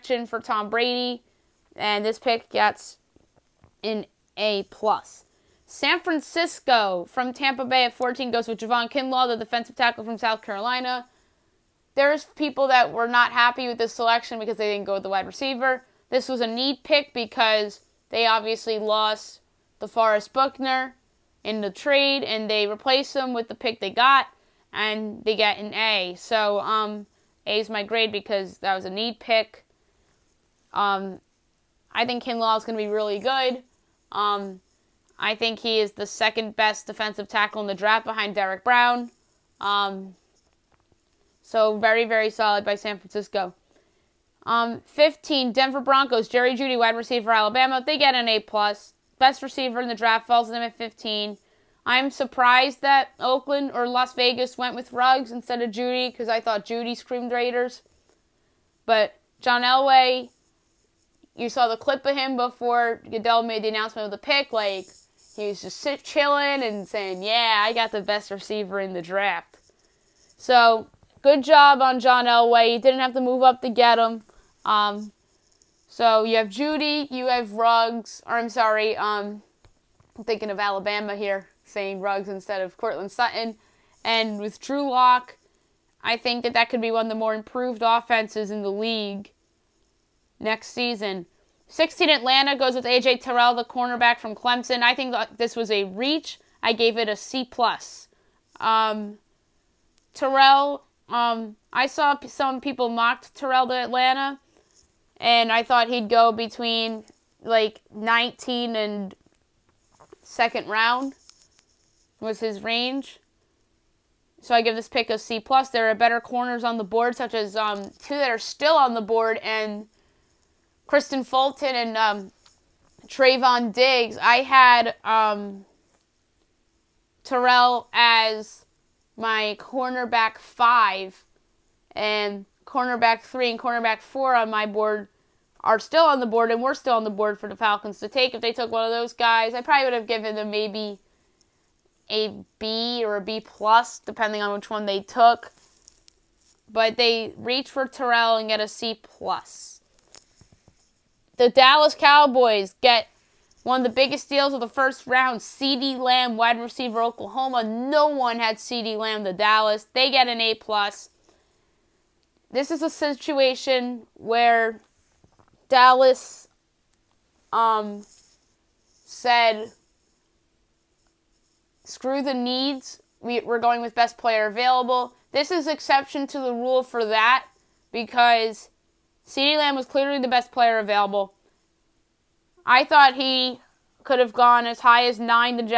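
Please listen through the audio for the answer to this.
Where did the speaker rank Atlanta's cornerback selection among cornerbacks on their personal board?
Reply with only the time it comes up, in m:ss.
2:09.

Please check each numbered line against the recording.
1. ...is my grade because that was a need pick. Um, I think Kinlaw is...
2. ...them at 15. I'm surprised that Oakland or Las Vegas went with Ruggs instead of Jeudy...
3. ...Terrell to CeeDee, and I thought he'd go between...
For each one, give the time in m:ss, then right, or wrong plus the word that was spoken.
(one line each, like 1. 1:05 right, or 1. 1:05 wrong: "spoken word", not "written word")
1. 0:27 right
2. 0:50 right
3. 1:43 wrong: "Atlanta", not "CeeDee".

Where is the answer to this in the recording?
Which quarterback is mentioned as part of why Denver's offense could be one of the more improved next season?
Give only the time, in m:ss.
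1:24.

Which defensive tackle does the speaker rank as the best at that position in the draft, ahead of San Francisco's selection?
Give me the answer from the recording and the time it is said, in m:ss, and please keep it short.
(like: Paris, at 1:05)
Derrick Brown, at 0:38.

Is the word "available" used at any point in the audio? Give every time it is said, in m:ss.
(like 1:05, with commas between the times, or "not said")
2:54, 3:00.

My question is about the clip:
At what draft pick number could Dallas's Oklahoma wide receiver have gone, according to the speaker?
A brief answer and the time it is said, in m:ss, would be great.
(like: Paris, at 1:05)
9, at 3:05.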